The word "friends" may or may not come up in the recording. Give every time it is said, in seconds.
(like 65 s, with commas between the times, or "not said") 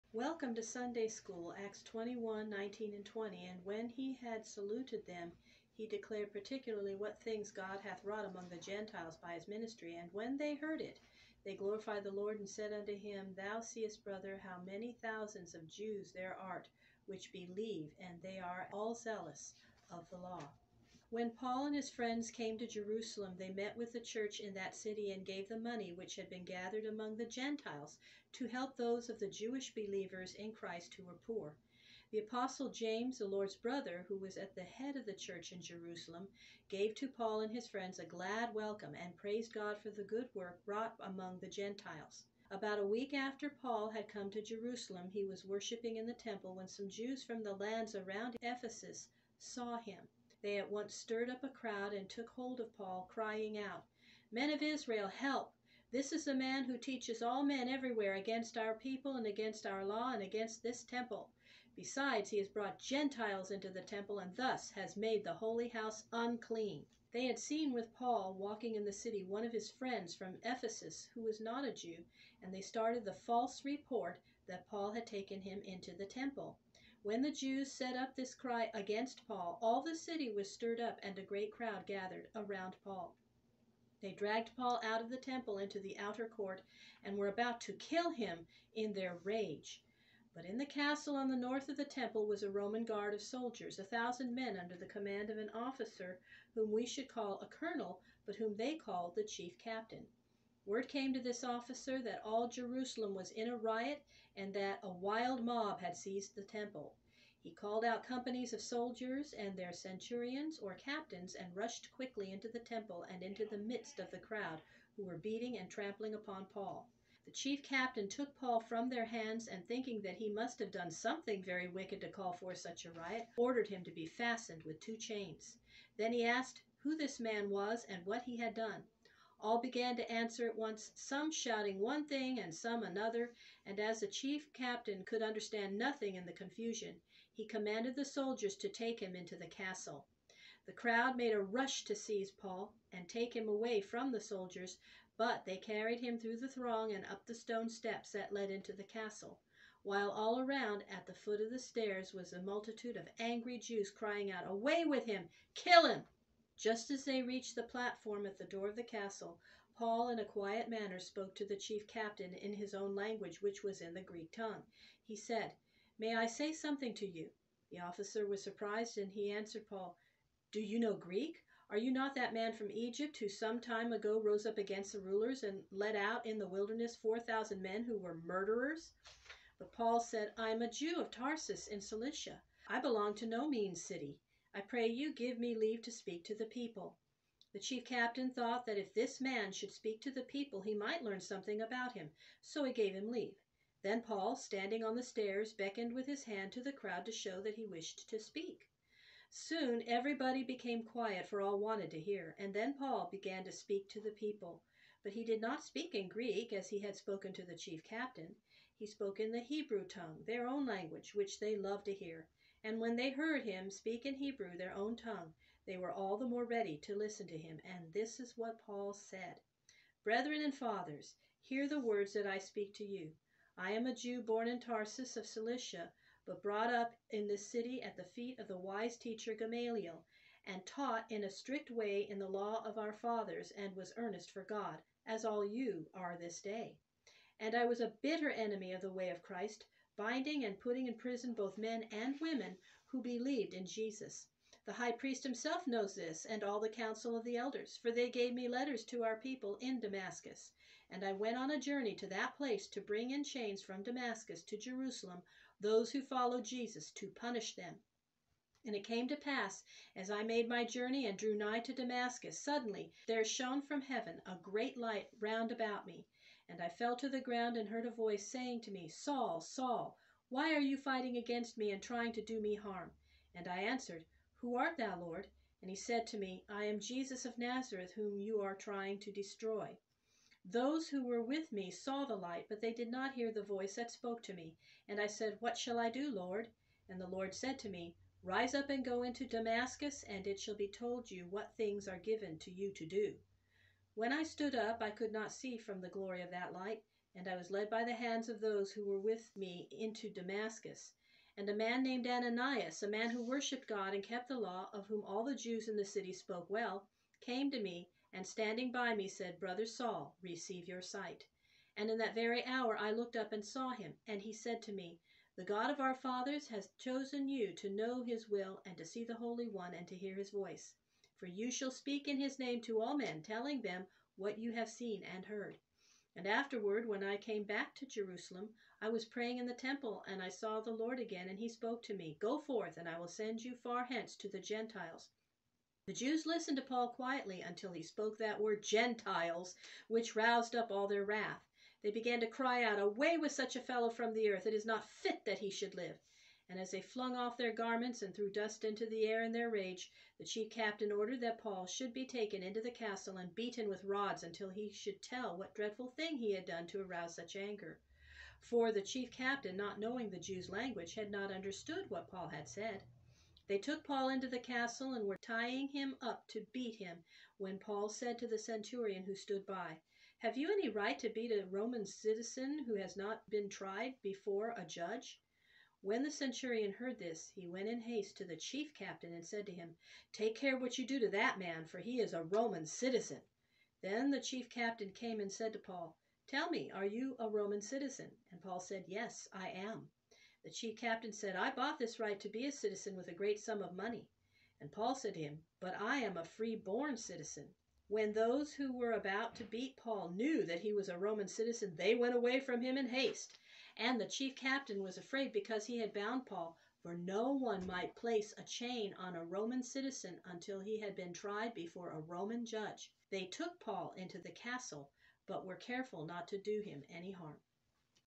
21 s, 37 s, 69 s.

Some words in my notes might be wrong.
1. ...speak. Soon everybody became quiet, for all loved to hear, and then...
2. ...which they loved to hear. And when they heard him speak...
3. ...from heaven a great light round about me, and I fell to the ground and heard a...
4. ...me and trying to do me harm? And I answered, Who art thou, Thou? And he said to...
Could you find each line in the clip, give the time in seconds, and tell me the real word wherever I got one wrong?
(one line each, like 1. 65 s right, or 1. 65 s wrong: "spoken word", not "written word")
1. 198 s wrong: "wanted", not "loved"
2. 211 s right
3. 263 s right
4. 271 s wrong: "Lord", not "Thou".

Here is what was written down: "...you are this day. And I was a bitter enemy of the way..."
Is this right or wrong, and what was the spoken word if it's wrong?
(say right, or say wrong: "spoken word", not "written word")
right.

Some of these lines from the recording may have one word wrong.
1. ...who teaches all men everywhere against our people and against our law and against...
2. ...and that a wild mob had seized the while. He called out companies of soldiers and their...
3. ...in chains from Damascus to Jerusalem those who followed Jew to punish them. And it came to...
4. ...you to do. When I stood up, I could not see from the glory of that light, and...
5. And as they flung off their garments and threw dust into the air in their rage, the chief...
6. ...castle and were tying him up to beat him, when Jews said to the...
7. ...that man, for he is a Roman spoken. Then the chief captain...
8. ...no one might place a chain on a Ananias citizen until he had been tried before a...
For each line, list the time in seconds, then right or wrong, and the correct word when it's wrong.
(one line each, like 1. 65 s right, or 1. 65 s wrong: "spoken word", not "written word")
1. 56 s right
2. 104 s wrong: "temple", not "while"
3. 253 s wrong: "Jesus", not "Jew"
4. 292 s right
5. 346 s right
6. 364 s wrong: "Paul", not "Jews"
7. 381 s wrong: "citizen", not "spoken"
8. 406 s wrong: "Roman", not "Ananias".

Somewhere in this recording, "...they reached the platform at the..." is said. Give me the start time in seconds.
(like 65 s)
157 s.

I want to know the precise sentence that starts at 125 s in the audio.
Then he asked who this man was and what he had done.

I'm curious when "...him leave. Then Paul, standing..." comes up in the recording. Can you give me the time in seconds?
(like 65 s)
192 s.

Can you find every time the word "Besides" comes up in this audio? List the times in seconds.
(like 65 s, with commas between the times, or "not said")
61 s.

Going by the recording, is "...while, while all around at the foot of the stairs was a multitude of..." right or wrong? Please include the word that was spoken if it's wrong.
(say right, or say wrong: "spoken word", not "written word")
wrong: "castle", not "while".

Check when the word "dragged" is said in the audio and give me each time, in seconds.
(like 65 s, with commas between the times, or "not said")
84 s.